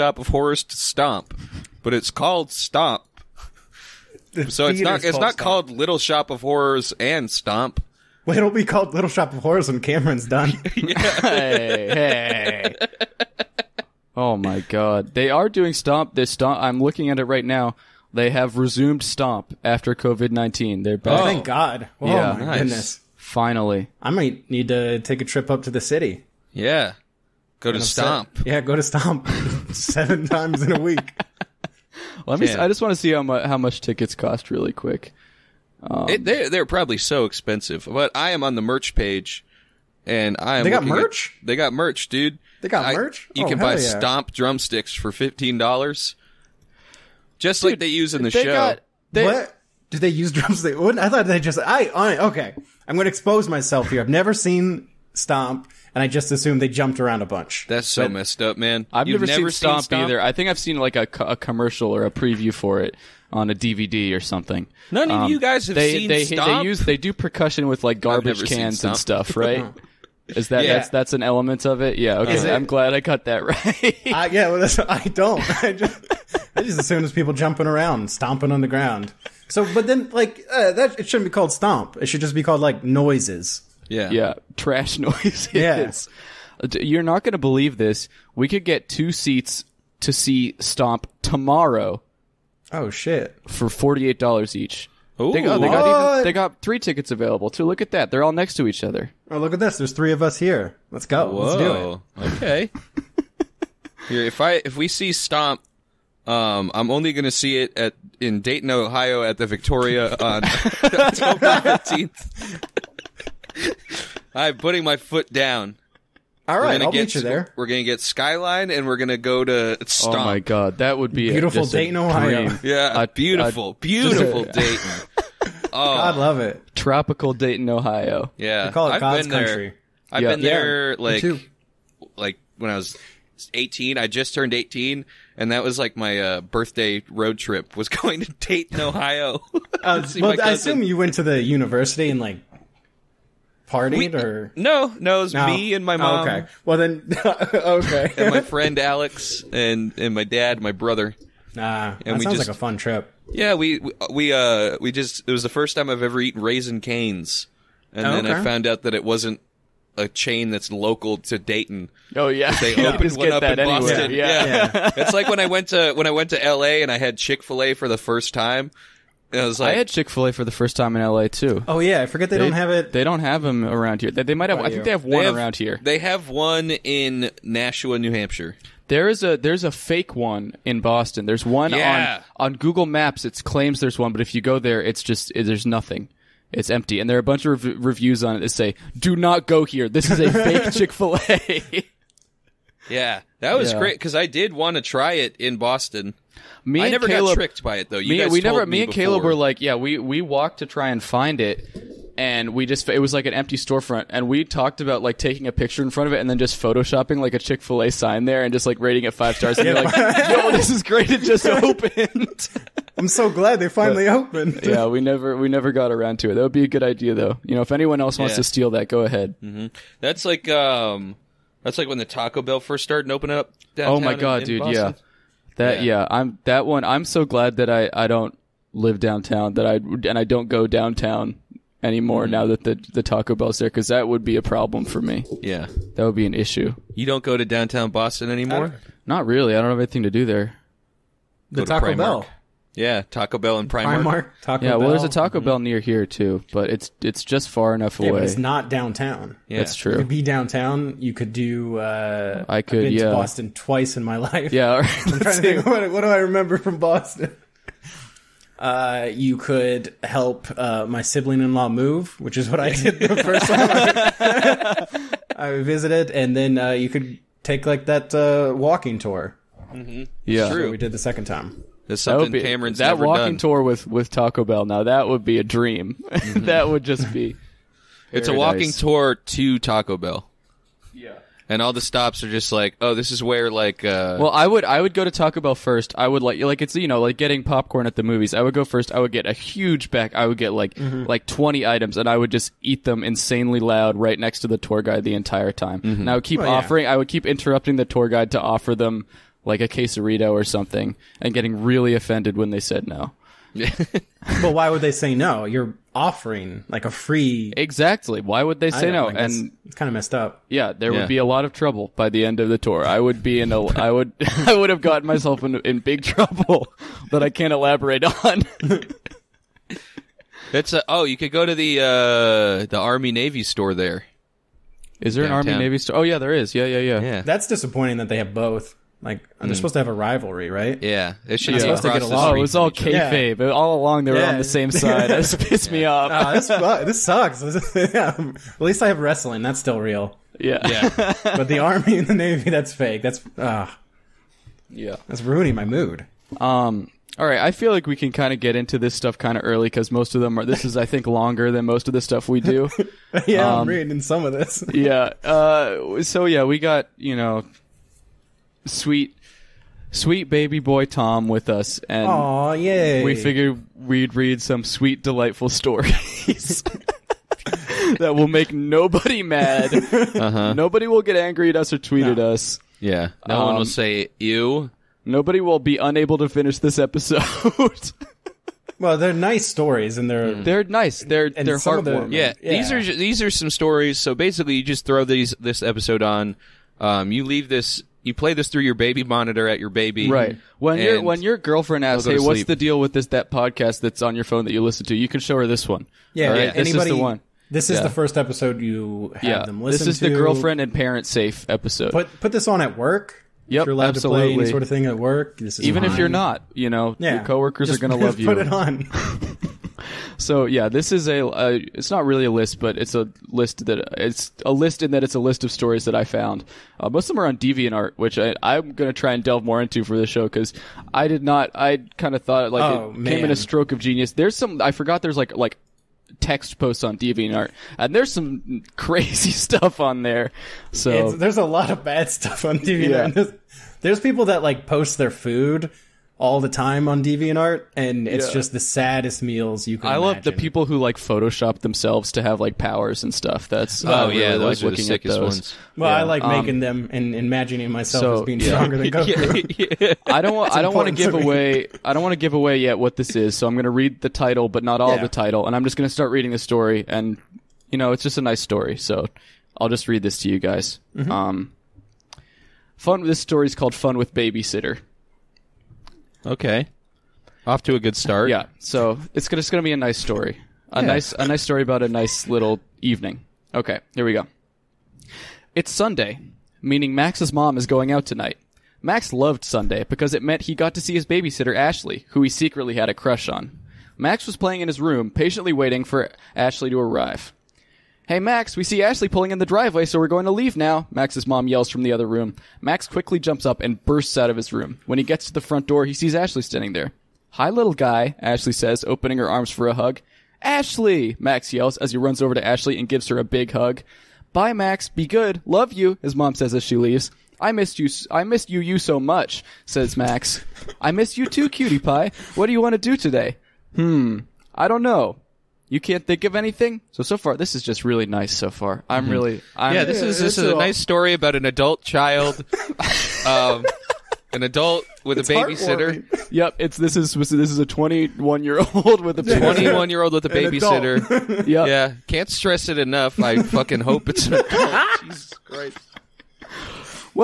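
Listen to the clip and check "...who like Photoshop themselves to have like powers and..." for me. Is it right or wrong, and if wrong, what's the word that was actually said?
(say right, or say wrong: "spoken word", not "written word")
right.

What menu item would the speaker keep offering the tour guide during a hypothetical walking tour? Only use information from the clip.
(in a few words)
a quesarito.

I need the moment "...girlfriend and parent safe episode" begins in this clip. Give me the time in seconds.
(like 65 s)
400 s.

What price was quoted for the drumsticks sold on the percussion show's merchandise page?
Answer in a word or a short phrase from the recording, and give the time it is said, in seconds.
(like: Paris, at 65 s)
$15, at 45 s.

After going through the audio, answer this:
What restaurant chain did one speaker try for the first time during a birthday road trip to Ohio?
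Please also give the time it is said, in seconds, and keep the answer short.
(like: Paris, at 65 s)
Raising Cane's, at 156 s.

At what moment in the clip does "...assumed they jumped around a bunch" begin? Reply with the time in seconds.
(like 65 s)
56 s.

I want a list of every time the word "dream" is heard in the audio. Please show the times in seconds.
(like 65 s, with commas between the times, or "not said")
275 s.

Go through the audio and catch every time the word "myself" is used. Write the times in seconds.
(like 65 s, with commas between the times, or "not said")
53 s, 315 s, 447 s.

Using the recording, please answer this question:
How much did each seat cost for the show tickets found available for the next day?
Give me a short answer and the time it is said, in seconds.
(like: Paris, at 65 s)
$48, at 93 s.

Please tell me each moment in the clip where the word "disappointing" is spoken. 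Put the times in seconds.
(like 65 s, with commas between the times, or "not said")
327 s.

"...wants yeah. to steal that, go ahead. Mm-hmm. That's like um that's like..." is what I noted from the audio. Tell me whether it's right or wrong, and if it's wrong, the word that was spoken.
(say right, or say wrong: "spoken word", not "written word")
right.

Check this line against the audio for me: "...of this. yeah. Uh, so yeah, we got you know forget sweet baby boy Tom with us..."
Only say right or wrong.
wrong.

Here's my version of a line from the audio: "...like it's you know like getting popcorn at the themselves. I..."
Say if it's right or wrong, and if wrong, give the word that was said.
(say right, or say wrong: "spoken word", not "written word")
wrong: "movies", not "themselves".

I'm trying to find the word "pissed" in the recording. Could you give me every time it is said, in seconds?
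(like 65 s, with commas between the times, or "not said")
335 s.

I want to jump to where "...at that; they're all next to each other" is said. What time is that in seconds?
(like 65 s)
97 s.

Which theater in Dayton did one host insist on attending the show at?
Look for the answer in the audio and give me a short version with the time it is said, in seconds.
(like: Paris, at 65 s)
the Victoria, at 109 s.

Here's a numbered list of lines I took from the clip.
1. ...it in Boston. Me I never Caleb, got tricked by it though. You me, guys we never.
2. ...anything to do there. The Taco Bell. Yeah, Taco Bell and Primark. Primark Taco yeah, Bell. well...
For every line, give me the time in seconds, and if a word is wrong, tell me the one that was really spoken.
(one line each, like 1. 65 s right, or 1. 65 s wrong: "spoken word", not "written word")
1. 195 s right
2. 239 s right.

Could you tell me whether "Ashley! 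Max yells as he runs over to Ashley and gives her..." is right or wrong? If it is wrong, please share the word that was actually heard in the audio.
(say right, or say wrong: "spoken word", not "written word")
right.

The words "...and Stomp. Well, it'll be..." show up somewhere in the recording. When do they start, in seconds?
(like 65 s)
6 s.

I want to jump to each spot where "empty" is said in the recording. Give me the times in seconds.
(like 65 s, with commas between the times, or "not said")
186 s, 203 s.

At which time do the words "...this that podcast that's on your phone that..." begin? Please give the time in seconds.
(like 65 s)
392 s.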